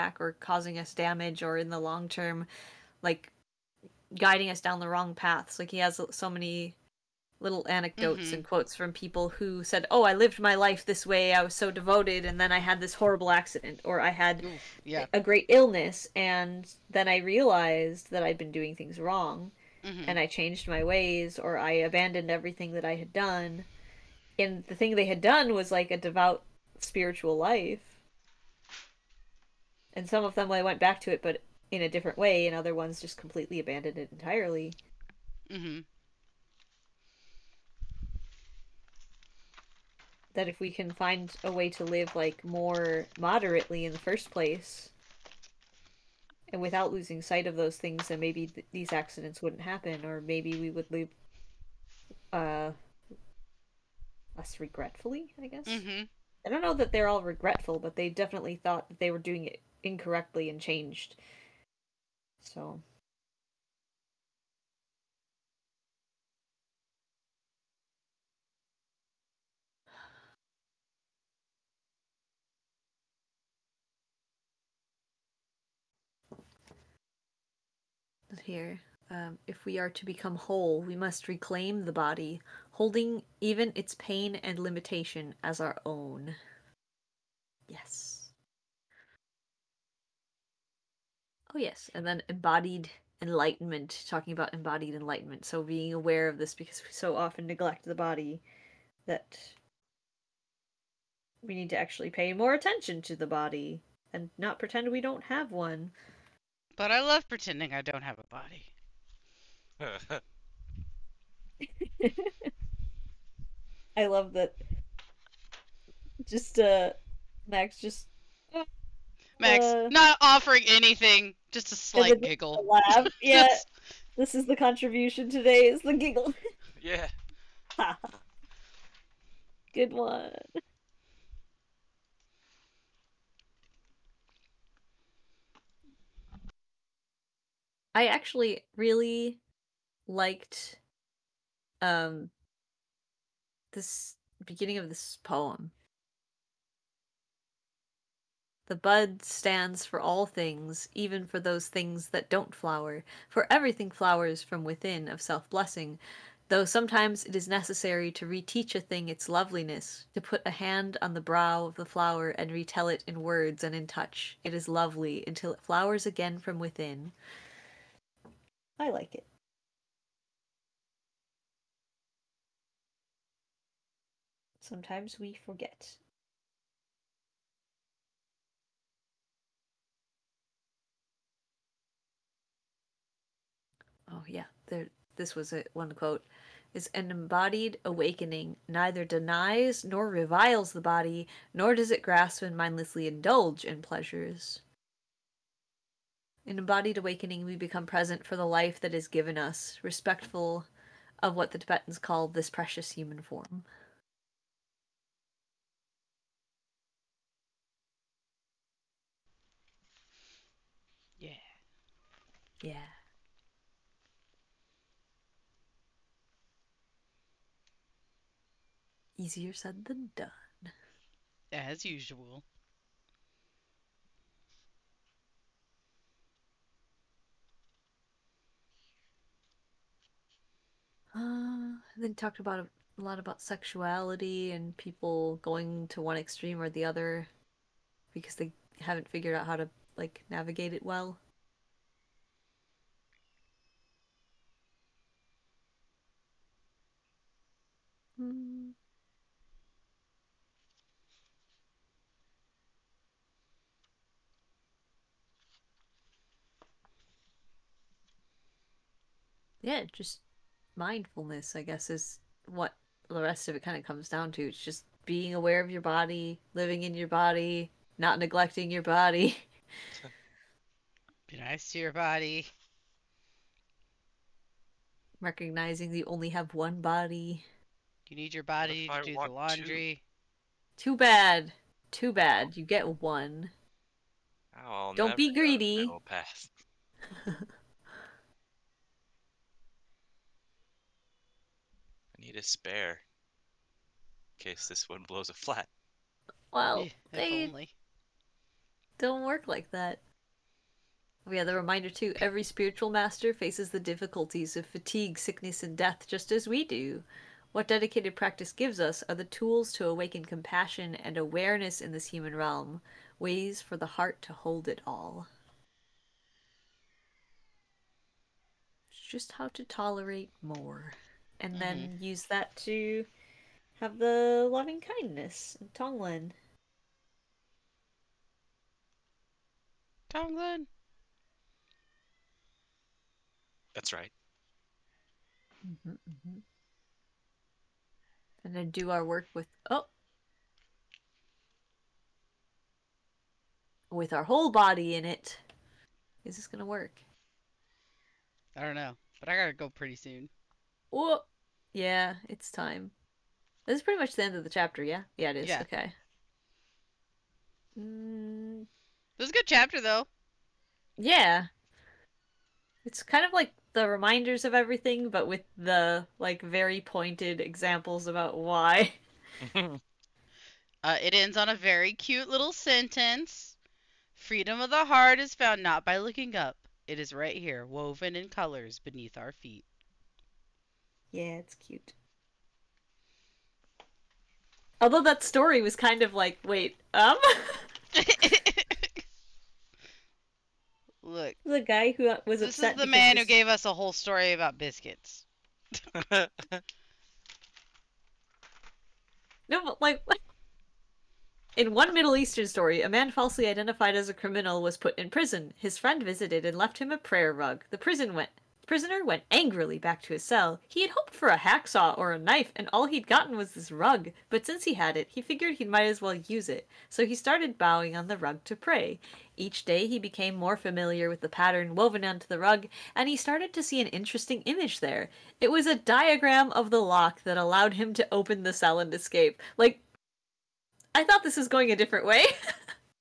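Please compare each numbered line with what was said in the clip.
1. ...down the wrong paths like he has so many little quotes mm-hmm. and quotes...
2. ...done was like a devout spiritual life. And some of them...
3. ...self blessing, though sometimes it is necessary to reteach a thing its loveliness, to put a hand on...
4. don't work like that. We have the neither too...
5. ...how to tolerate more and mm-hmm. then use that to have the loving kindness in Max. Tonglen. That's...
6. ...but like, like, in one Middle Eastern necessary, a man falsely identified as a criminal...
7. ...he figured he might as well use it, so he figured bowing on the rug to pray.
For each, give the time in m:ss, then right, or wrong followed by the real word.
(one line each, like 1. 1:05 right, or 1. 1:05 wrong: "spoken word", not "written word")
1. 0:04 wrong: "anecdotes", not "quotes"
2. 0:25 right
3. 2:35 right
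4. 4:58 wrong: "reminder", not "neither"
5. 5:19 wrong: "Tonglen", not "Max"
6. 6:39 wrong: "story", not "necessary"
7. 6:55 wrong: "started", not "figured".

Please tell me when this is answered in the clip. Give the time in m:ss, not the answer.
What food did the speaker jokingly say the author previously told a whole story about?
6:34.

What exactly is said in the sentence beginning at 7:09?
Like, I thought this was going a different way.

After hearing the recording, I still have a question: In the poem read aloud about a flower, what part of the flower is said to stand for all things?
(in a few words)
The bud.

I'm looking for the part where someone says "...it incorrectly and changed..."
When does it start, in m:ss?
0:59.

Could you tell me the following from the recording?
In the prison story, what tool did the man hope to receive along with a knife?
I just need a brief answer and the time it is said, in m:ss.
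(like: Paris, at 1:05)
A hacksaw, at 6:51.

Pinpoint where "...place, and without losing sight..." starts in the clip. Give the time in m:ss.
0:44.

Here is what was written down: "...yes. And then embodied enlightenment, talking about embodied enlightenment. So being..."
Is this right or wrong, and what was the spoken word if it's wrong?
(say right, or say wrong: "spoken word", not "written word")
right.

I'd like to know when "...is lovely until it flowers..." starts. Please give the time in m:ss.
2:44.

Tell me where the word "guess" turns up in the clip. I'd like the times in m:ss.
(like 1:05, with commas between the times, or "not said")
0:55, 4:21.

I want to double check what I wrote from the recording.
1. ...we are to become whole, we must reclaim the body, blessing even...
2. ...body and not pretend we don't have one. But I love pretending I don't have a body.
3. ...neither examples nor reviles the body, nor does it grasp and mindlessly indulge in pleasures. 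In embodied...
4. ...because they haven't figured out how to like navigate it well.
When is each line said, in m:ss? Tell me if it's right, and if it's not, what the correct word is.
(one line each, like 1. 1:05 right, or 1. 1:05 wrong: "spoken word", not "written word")
1. 1:19 wrong: "holding", not "blessing"
2. 1:43 right
3. 3:08 wrong: "denies", not "examples"
4. 3:58 right.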